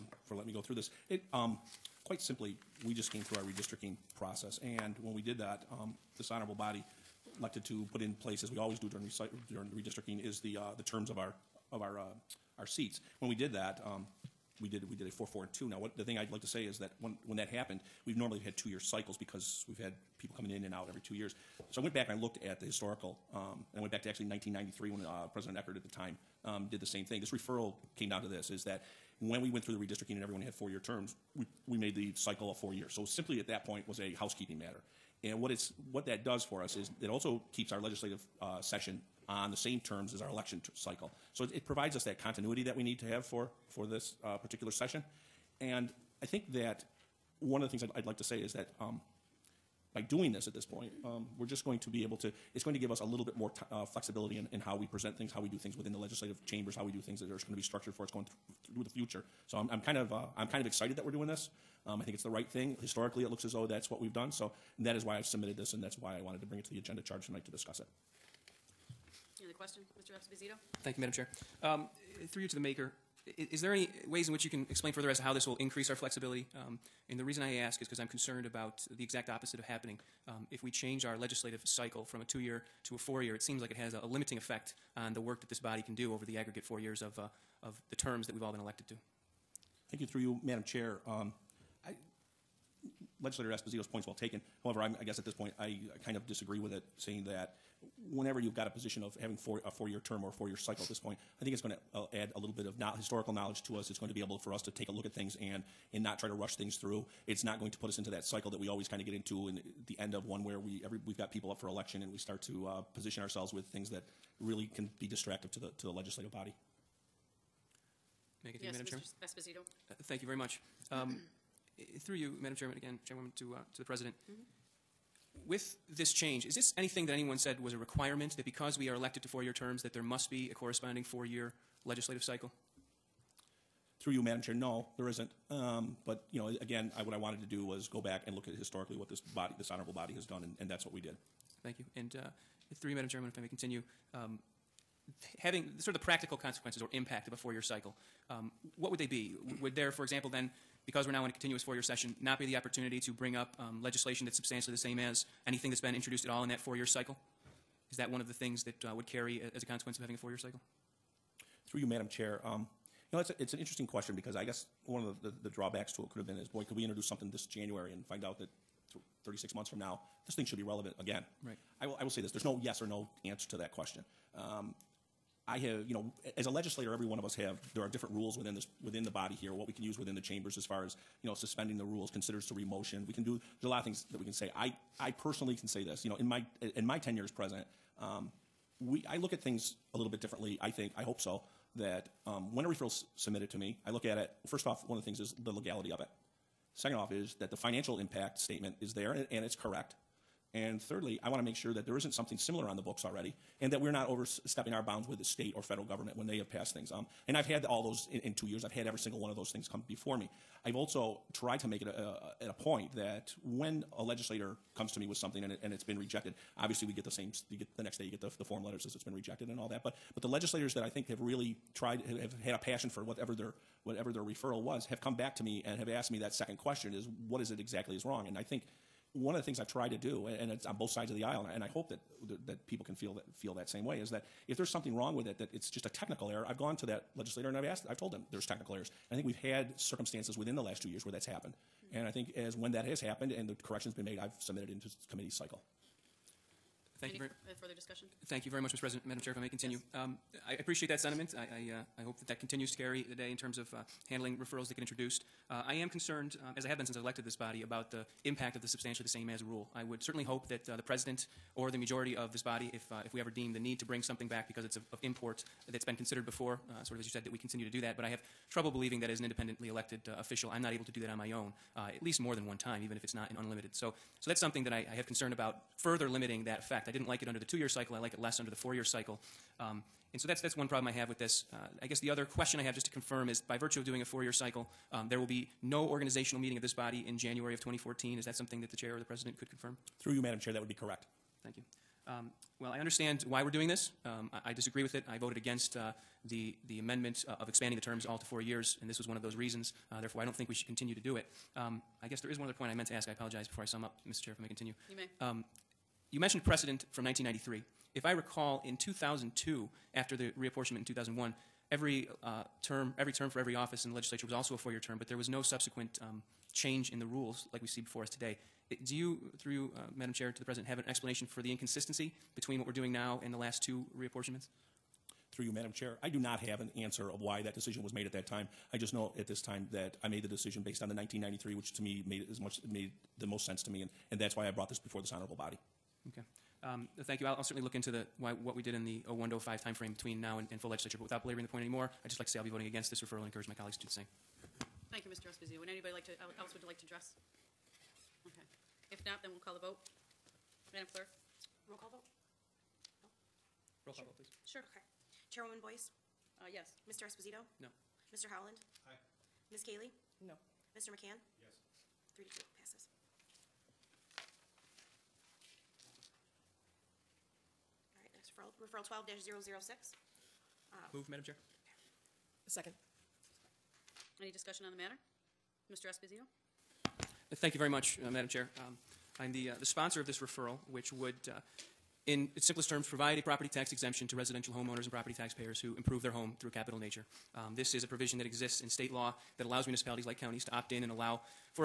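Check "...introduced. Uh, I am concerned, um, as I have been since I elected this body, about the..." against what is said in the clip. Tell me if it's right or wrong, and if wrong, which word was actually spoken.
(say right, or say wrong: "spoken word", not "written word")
right.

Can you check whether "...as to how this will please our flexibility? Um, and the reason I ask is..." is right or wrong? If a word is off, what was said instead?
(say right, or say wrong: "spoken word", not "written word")
wrong: "increase", not "please".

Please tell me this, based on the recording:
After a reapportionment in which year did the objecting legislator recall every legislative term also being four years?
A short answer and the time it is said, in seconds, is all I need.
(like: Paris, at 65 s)
2001, at 310 s.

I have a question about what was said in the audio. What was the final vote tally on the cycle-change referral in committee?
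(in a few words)
3 to 2.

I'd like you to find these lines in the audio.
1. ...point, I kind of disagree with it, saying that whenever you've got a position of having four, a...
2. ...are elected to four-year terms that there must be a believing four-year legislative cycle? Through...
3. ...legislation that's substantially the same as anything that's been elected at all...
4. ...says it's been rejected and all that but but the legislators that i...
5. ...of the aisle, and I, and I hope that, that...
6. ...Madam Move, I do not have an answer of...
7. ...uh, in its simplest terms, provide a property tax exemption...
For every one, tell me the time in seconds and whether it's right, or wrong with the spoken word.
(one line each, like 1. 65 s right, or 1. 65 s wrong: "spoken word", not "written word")
1. 95 s right
2. 128 s wrong: "corresponding", not "believing"
3. 153 s wrong: "introduced", not "elected"
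4. 218 s right
5. 231 s right
6. 325 s wrong: "Chair", not "Move"
7. 381 s right.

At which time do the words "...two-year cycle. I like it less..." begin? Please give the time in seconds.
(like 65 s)
277 s.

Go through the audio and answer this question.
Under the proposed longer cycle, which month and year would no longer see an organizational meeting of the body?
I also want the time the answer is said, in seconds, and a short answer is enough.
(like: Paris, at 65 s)
January 2014, at 287 s.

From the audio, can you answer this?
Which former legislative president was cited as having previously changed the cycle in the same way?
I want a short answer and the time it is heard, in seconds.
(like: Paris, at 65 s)
Eckert, at 25 s.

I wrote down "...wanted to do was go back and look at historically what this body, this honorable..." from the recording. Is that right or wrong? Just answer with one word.
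right.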